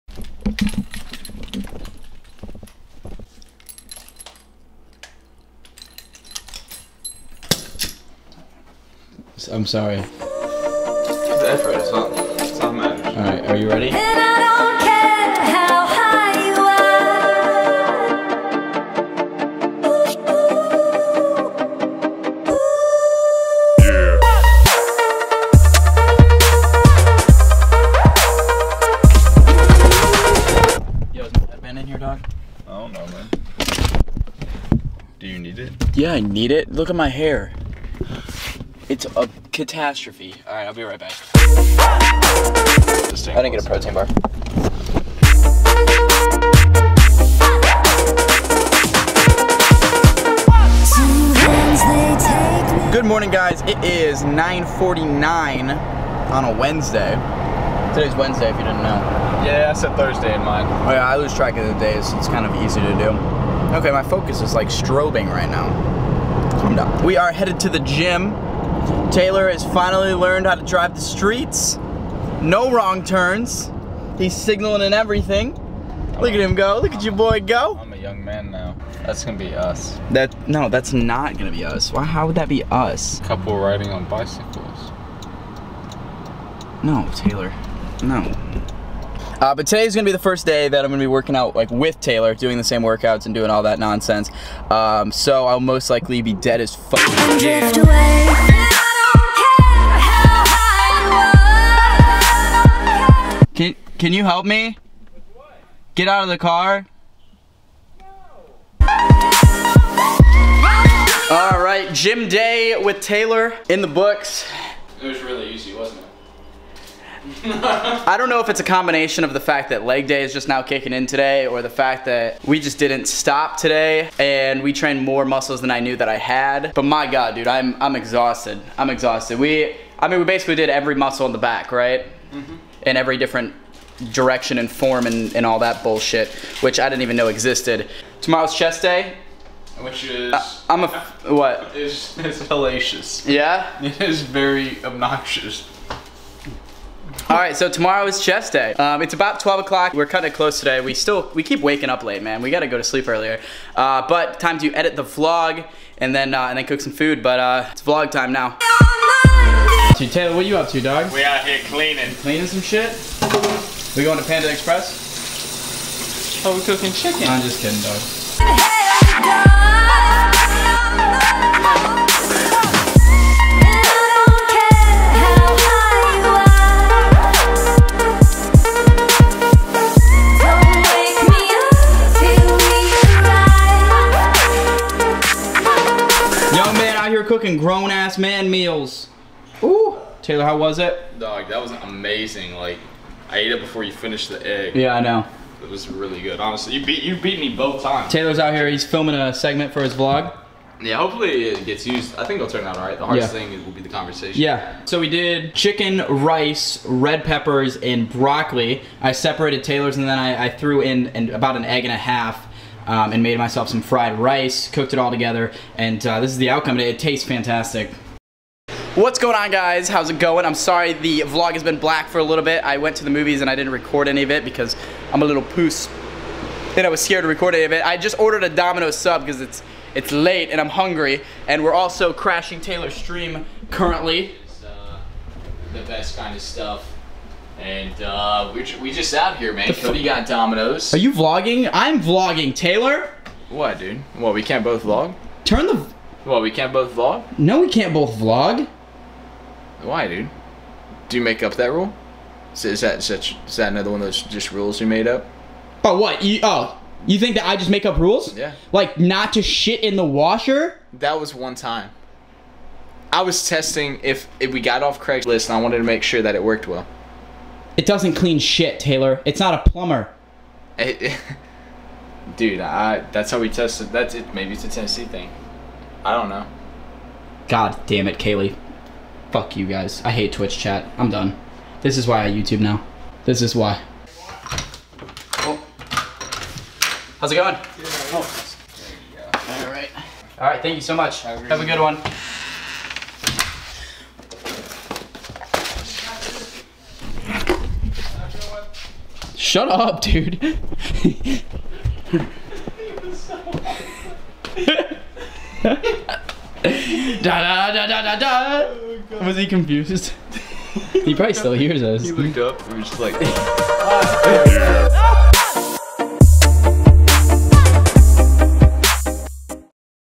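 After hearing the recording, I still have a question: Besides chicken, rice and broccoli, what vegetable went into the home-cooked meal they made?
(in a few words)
Red peppers.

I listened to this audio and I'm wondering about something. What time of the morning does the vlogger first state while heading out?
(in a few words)
9:49.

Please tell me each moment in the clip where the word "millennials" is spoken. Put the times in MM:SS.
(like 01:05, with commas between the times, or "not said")
not said.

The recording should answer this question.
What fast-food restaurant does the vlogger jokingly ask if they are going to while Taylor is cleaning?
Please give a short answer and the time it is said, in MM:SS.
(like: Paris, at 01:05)
Panda Express, at 02:44.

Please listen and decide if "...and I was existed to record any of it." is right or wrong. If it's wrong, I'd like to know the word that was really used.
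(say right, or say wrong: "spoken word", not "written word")
wrong: "scared", not "existed".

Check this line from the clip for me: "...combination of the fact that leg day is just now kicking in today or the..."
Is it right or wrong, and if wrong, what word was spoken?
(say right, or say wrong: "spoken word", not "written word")
right.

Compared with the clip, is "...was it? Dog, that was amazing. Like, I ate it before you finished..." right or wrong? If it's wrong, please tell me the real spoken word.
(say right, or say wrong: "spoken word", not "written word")
right.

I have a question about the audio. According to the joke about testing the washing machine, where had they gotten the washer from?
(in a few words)
Craigslist.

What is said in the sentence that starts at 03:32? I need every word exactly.
Um, and made myself some fried rice, cooked it all together, and uh, this is the outcome.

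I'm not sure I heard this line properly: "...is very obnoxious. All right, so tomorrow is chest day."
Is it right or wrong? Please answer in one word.
right.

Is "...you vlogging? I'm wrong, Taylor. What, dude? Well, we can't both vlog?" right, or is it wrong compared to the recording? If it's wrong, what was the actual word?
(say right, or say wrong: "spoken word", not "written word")
wrong: "vlogging", not "wrong".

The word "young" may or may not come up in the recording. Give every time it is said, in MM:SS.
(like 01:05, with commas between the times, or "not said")
01:17, 03:06.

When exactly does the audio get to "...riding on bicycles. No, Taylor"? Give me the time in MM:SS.
01:23.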